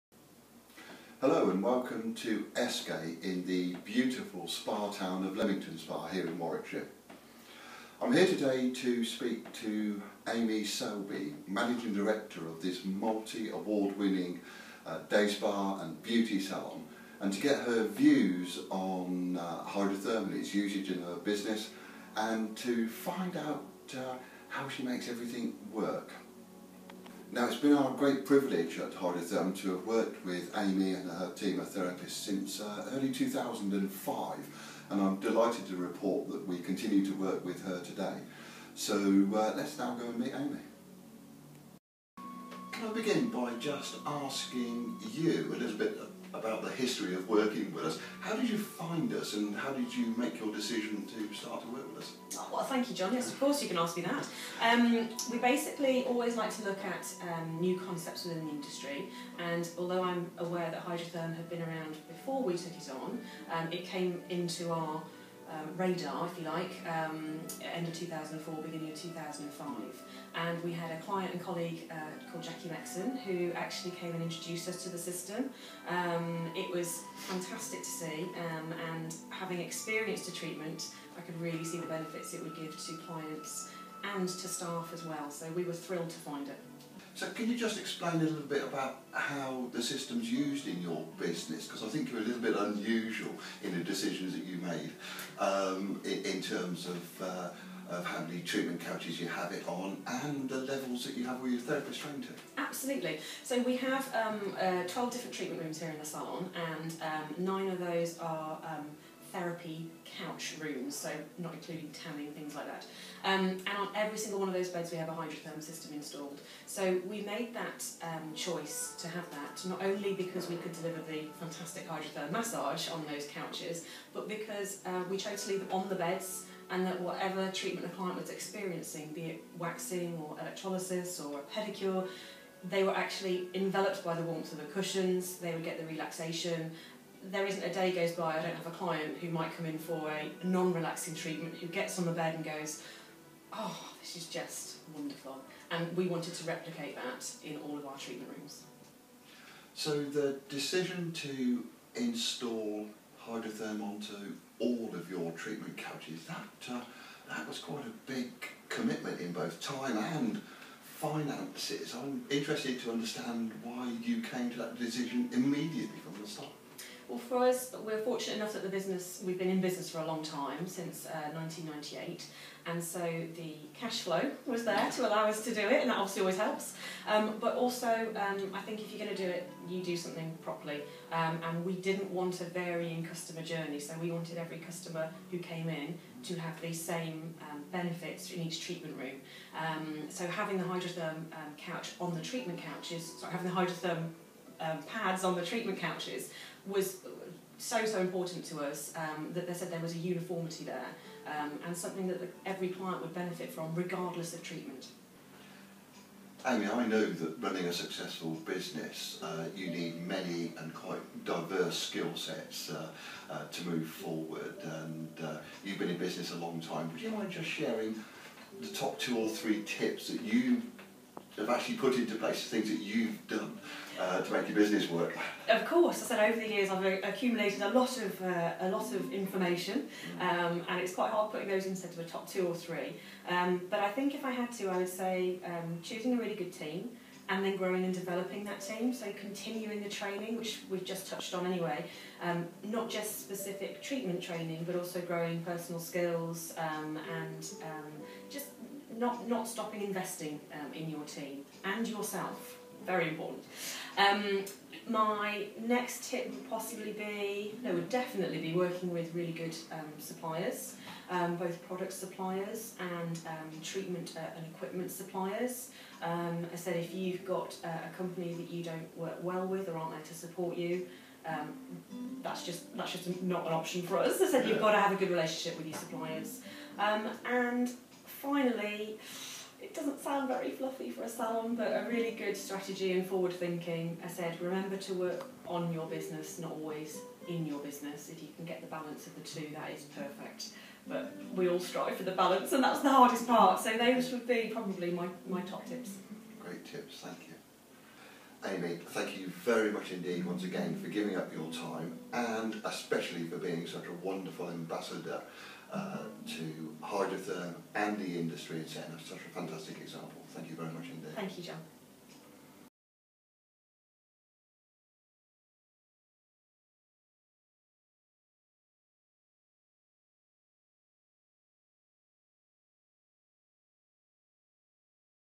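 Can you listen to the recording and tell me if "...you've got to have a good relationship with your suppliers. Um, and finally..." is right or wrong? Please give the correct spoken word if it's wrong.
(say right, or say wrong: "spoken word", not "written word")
right.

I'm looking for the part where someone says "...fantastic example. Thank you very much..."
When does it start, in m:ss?
5:09.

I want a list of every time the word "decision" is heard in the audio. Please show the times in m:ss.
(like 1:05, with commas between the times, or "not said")
0:50, 1:33, 2:30, 2:44.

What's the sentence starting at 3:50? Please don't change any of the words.
um, and it's quite hard putting those instead of a top two or three.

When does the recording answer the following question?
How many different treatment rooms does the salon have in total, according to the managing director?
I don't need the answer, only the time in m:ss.
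1:44.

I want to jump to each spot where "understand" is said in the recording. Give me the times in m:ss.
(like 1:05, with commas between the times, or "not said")
2:42.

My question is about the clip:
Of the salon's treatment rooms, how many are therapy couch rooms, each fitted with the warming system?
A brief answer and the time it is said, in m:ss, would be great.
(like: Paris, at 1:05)
9, at 1:47.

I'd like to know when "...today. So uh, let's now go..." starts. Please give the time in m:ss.
0:37.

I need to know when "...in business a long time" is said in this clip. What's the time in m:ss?
3:35.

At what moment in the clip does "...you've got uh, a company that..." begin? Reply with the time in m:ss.
4:26.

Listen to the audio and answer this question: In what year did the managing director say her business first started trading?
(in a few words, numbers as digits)
1998.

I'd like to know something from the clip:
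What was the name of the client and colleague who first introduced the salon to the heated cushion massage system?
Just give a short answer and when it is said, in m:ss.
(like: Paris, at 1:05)
Jackie Lexon, at 1:12.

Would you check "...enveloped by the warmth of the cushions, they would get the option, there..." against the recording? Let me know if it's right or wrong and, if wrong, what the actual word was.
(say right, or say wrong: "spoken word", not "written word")
wrong: "relaxation", not "option".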